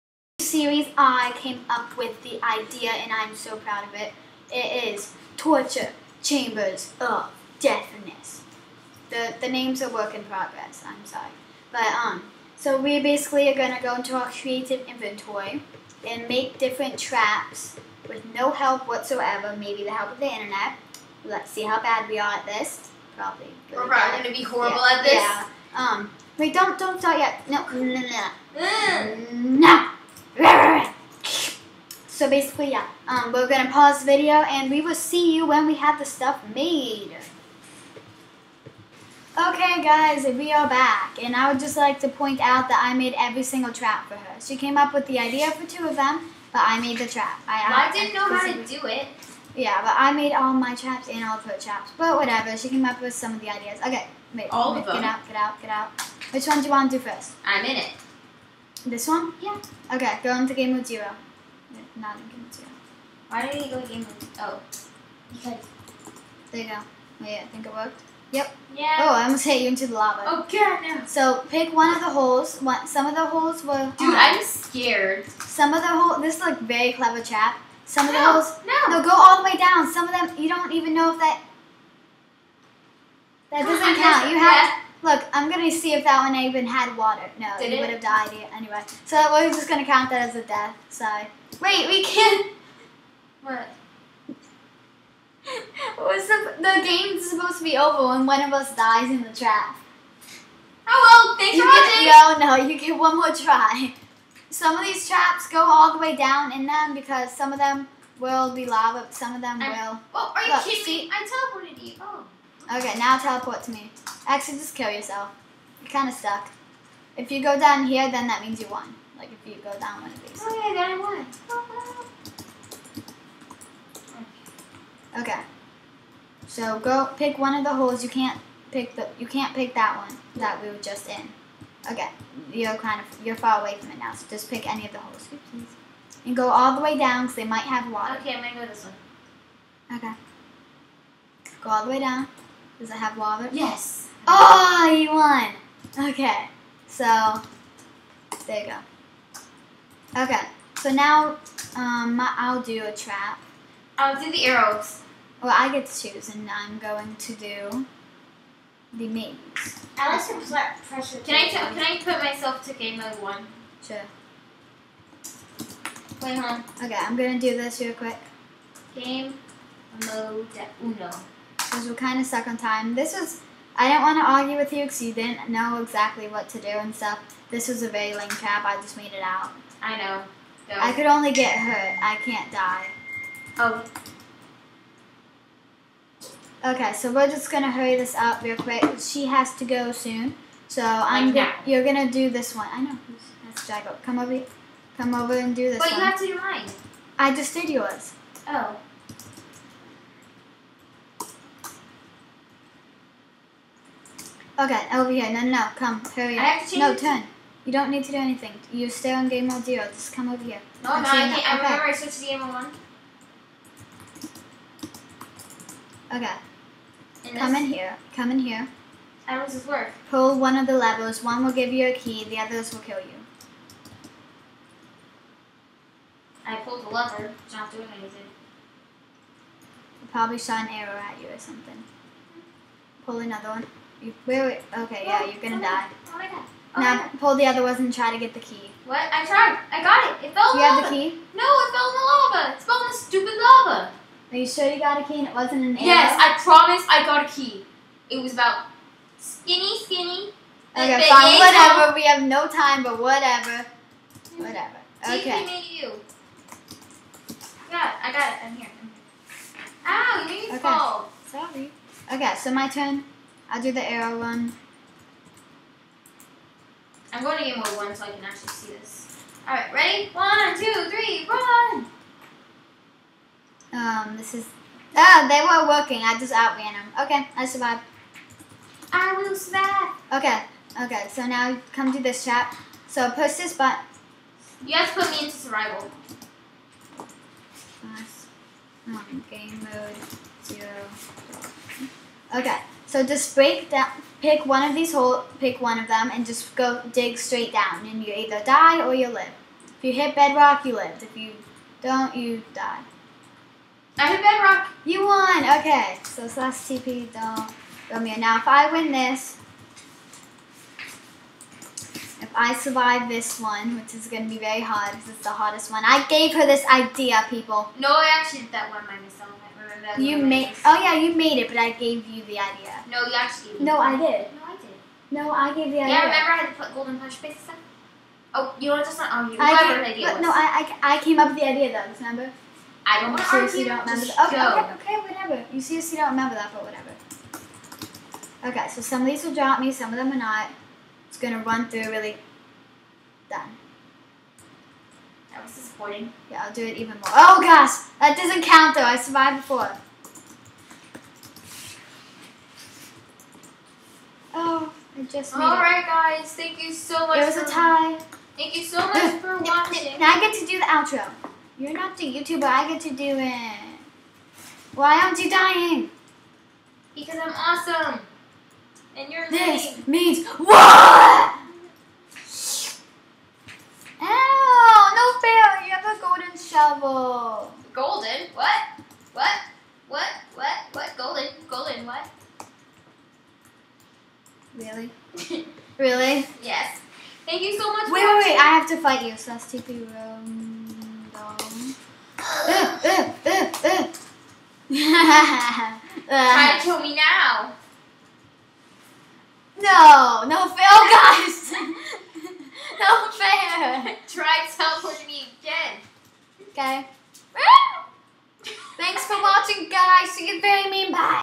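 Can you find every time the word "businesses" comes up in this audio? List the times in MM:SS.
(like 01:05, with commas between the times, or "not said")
not said.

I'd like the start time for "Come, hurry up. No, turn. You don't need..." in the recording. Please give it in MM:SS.
03:25.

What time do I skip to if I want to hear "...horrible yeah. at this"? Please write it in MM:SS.
00:24.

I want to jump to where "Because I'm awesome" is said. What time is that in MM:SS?
06:06.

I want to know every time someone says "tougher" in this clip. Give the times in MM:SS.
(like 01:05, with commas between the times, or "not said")
not said.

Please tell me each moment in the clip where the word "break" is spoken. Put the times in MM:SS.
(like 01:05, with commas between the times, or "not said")
04:53.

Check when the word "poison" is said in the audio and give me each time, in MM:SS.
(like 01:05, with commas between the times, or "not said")
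not said.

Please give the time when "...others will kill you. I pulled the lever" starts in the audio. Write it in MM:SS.
03:42.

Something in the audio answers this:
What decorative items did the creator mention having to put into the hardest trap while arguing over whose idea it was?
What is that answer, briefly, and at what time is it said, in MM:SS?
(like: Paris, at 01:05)
Golden punch faces, at 05:26.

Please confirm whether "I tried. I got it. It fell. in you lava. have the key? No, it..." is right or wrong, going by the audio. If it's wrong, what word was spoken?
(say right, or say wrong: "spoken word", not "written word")
right.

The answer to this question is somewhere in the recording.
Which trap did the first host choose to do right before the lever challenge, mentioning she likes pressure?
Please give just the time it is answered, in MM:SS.
02:38.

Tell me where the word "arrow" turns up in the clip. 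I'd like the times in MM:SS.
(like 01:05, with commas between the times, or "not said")
02:34, 03:50, 04:05, 04:23.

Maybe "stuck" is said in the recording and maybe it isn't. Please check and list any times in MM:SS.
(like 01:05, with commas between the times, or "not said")
01:56, 02:52.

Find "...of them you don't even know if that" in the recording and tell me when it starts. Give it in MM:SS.
01:20.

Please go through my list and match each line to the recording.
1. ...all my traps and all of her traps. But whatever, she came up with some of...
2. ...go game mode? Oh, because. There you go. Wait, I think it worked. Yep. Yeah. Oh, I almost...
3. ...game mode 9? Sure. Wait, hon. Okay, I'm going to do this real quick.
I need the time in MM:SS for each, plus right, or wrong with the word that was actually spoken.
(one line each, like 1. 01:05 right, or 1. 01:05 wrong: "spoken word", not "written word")
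1. 00:50 right
2. 01:03 right
3. 02:42 wrong: "1", not "9".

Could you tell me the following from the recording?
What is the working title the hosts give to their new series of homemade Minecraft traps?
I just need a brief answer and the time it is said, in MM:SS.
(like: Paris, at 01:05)
Torture Chambers of Deathness, at 00:05.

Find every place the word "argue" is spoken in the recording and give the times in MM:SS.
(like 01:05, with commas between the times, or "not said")
02:54, 05:33.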